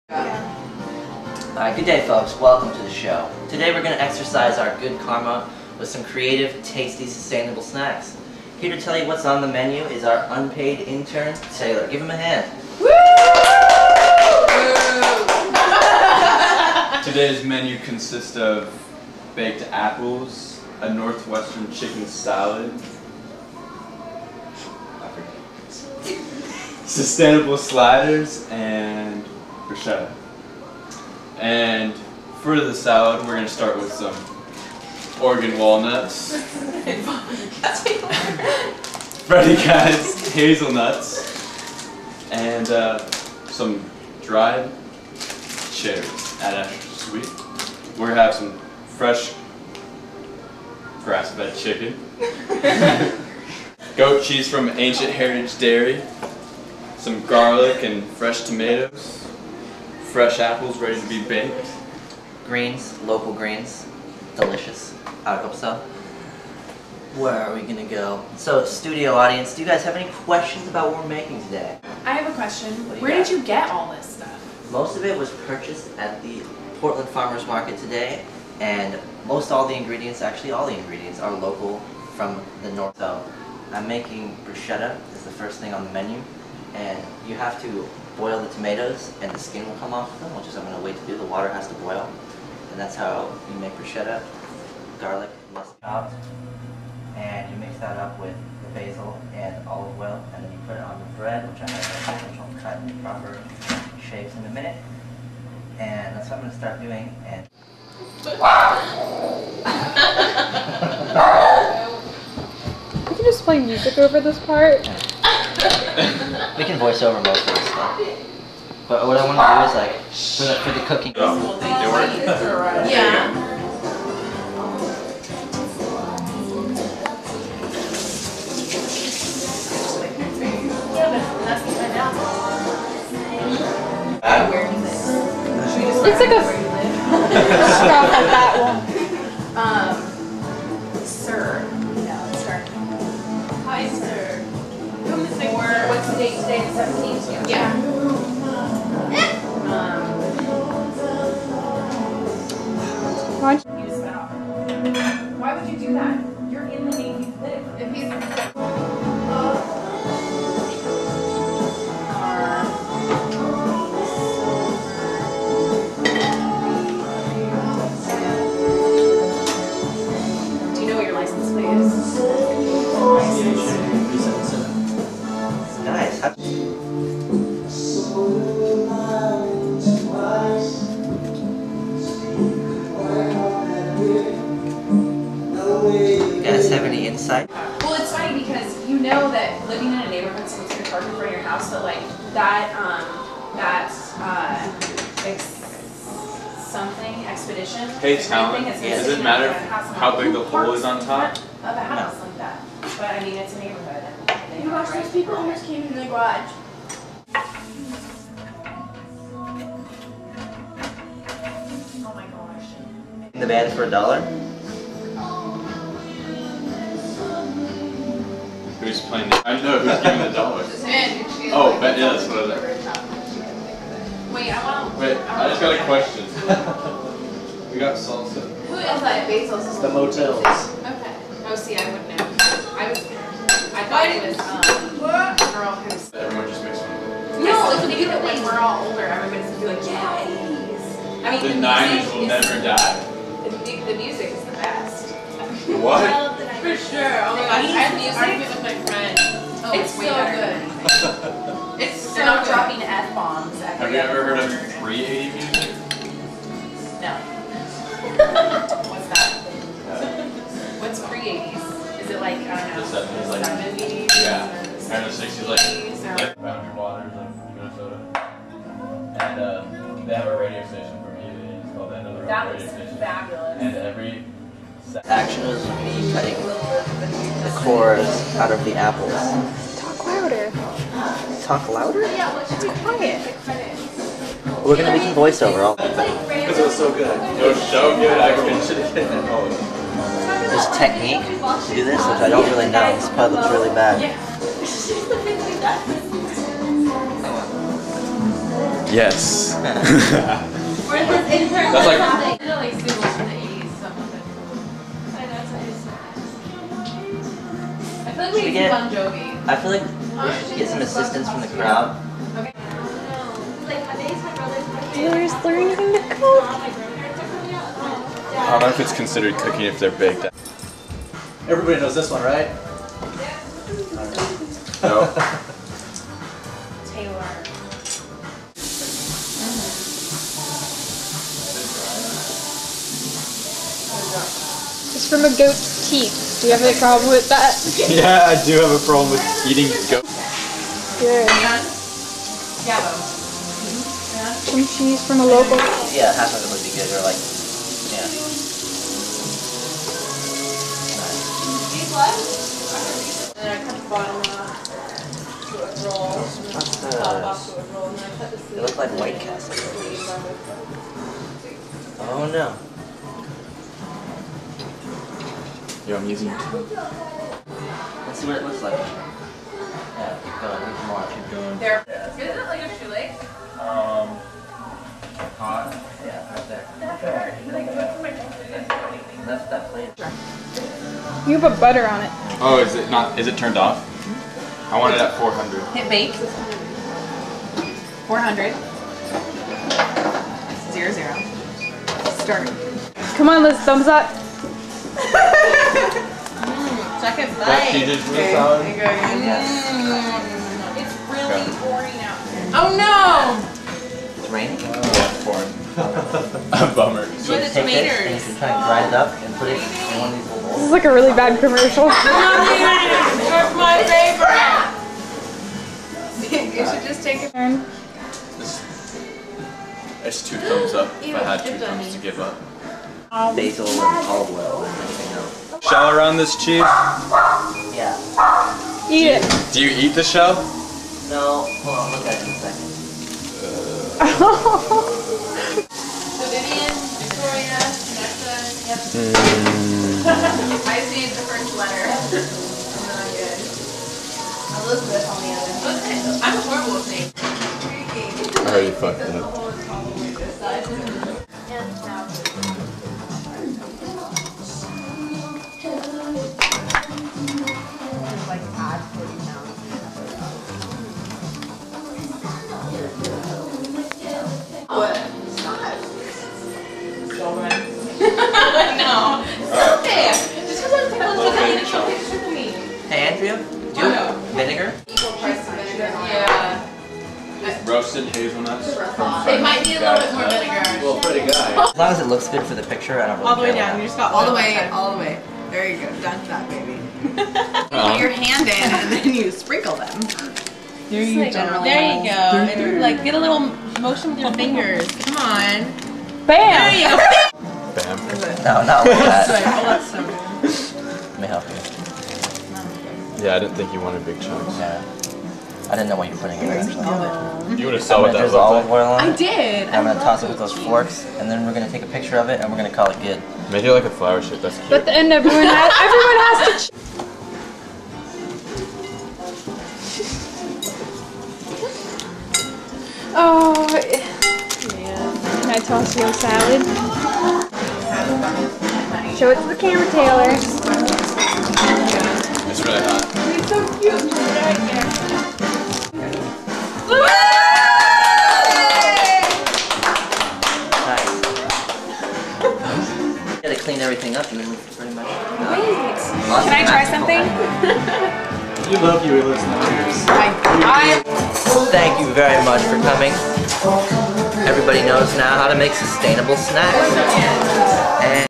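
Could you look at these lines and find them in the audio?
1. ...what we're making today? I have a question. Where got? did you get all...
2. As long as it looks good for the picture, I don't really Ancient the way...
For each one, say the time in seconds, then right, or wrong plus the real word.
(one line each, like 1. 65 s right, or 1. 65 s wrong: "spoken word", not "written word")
1. 70 s right
2. 481 s wrong: "All", not "Ancient".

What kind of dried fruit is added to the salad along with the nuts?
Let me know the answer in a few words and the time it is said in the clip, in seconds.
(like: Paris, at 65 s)
Cherries, at 44 s.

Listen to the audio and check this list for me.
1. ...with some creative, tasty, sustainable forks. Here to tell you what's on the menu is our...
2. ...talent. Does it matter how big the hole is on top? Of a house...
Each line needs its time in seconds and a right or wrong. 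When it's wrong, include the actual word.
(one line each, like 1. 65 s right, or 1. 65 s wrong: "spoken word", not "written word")
1. 5 s wrong: "snacks", not "forks"
2. 198 s right.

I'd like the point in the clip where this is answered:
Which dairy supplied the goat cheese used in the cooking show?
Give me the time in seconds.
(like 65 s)
54 s.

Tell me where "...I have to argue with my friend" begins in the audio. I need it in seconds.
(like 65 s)
247 s.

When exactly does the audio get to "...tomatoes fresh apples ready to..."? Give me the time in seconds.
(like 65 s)
58 s.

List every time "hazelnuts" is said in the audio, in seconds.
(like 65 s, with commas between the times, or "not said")
40 s, 478 s.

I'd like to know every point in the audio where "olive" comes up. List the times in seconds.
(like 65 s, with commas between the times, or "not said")
99 s, 424 s, 508 s.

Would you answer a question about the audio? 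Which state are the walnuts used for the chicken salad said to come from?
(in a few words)
Oregon.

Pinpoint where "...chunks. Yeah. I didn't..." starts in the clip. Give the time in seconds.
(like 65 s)
504 s.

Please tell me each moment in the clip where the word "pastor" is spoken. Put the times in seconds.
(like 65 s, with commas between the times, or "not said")
not said.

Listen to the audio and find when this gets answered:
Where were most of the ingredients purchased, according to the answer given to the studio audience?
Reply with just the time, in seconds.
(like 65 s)
76 s.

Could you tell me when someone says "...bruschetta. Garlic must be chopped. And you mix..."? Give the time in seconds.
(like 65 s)
93 s.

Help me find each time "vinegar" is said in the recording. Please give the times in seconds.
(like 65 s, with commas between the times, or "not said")
474 s, 480 s.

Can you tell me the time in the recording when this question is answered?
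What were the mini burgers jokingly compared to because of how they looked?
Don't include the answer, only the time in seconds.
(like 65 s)
358 s.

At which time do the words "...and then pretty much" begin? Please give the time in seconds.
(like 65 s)
544 s.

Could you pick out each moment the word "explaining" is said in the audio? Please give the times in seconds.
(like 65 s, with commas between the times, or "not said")
not said.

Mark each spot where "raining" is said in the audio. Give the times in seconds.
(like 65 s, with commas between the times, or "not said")
404 s.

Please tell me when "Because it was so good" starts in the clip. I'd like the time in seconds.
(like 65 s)
285 s.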